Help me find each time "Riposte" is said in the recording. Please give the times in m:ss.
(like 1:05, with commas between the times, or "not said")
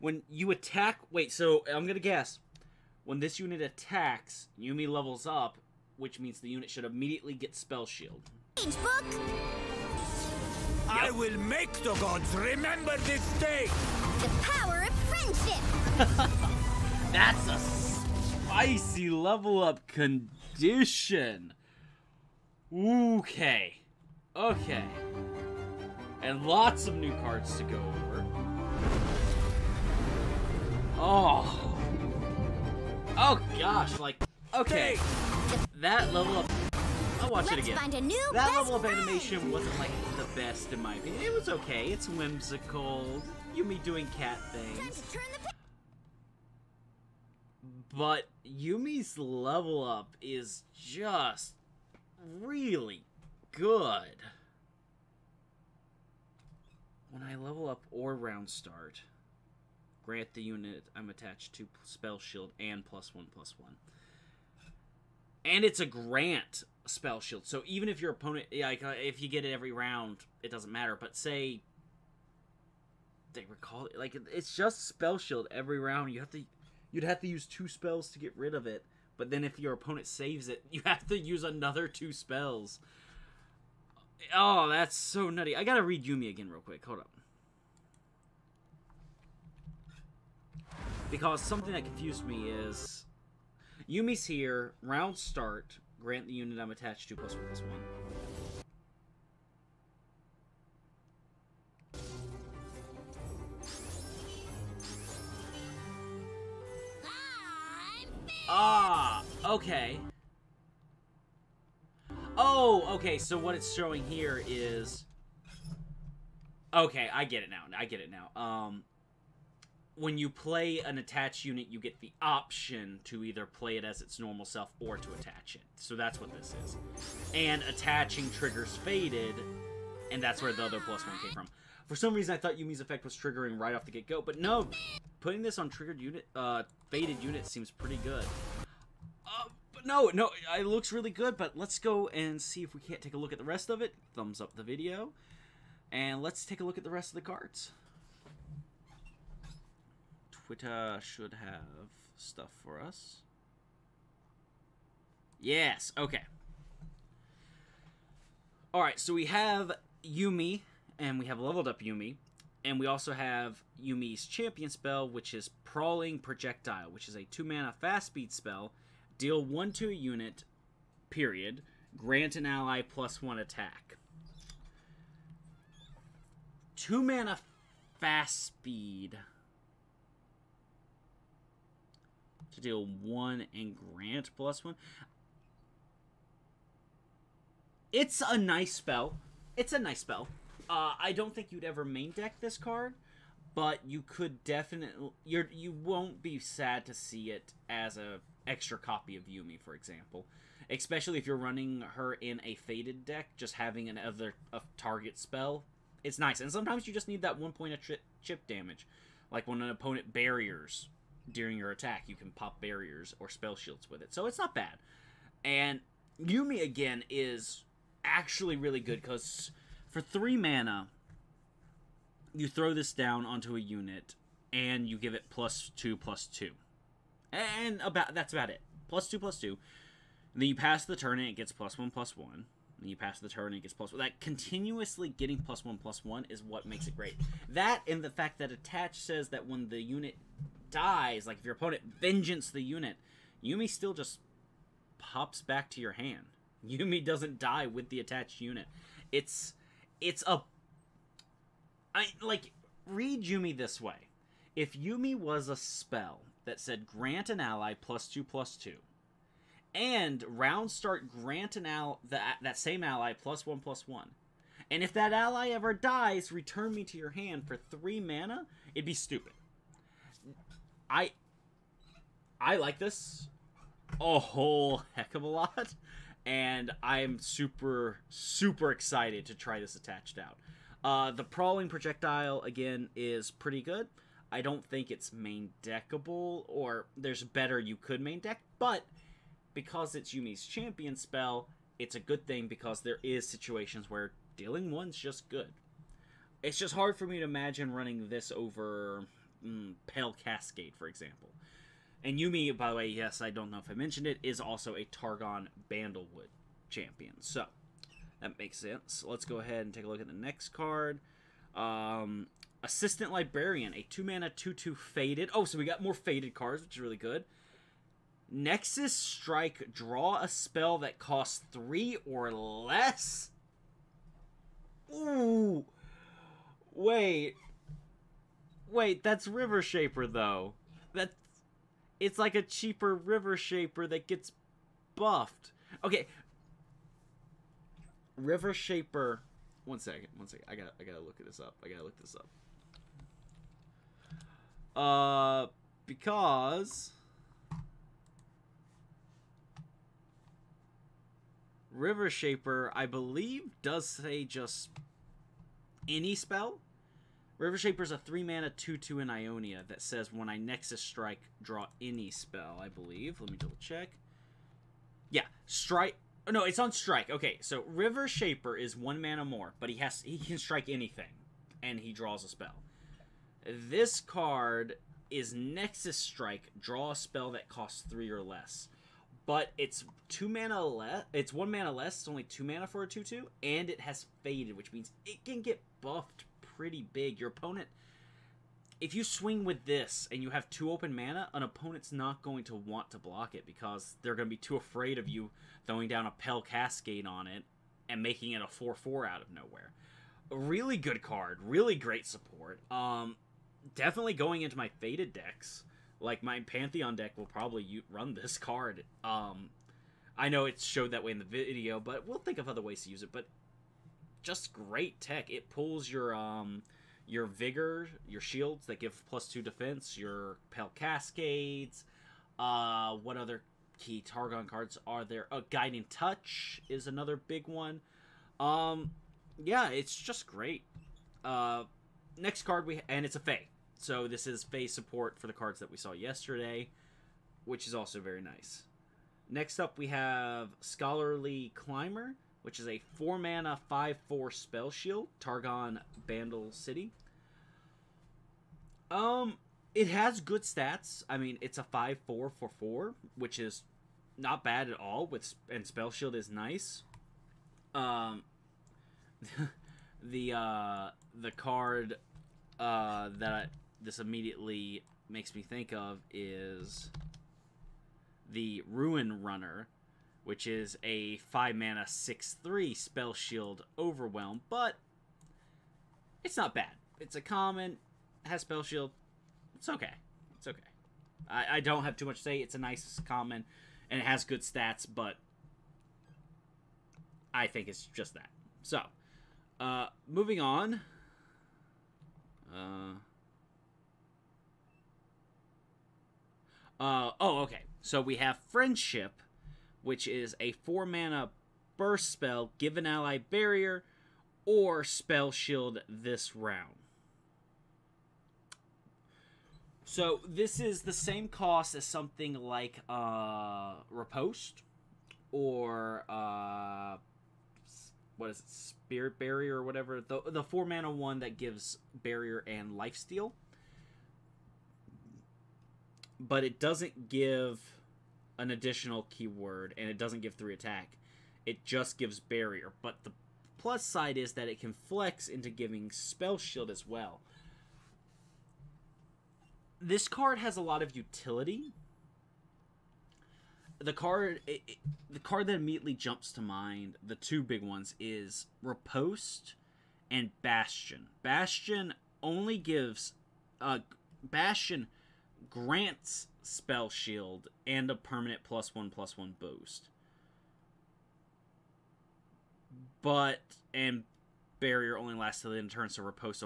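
8:33, 9:08.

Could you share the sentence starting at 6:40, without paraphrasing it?
A really good card, really great support.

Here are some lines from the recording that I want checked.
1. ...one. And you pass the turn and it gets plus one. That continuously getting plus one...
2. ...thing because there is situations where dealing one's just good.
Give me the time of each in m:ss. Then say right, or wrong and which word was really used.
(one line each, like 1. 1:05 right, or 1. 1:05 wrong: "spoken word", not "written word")
1. 3:52 right
2. 4:52 right.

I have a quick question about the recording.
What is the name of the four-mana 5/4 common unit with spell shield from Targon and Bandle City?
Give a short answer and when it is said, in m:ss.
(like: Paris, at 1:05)
Scholarly Climber, at 7:20.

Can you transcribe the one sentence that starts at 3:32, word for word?
You can pop barriers or spell shields with it.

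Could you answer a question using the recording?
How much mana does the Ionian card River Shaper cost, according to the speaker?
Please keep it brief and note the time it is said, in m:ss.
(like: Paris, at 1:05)
3, at 5:57.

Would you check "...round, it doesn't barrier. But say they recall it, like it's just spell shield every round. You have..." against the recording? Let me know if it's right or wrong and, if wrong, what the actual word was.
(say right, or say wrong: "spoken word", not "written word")
wrong: "matter", not "barrier".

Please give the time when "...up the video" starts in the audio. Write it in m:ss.
2:24.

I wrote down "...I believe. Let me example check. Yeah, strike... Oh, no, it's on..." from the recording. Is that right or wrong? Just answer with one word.
wrong.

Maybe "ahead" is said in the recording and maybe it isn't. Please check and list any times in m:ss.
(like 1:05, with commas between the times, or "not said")
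5:09.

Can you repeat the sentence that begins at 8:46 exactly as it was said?
But it doesn't give an additional keyword and it doesn't give three attack.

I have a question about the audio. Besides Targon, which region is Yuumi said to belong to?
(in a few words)
Bandlewood.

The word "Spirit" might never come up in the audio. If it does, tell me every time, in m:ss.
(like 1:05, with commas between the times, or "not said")
8:38.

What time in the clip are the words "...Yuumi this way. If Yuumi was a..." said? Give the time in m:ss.
4:13.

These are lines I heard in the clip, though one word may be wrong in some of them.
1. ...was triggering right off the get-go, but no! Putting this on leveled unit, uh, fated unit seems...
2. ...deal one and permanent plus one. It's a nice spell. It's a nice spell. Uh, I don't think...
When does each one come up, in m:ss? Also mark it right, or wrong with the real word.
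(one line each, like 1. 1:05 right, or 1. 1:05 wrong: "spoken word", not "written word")
1. 2:13 wrong: "triggered", not "leveled"
2. 3:02 wrong: "grant", not "permanent".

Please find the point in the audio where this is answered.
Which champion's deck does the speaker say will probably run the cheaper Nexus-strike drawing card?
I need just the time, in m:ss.
6:46.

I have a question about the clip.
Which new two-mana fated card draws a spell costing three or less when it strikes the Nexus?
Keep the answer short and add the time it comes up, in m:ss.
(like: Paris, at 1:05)
Assistant Librarian, at 5:12.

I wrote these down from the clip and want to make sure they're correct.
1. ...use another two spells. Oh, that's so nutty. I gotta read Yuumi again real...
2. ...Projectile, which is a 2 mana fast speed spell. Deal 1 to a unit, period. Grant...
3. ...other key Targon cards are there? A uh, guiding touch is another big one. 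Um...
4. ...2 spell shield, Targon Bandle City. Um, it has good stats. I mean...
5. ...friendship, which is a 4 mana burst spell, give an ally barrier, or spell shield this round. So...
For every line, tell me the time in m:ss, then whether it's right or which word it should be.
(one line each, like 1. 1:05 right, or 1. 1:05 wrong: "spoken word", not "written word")
1. 1:21 right
2. 2:46 right
3. 7:03 right
4. 7:24 wrong: "4", not "2"
5. 8:18 right.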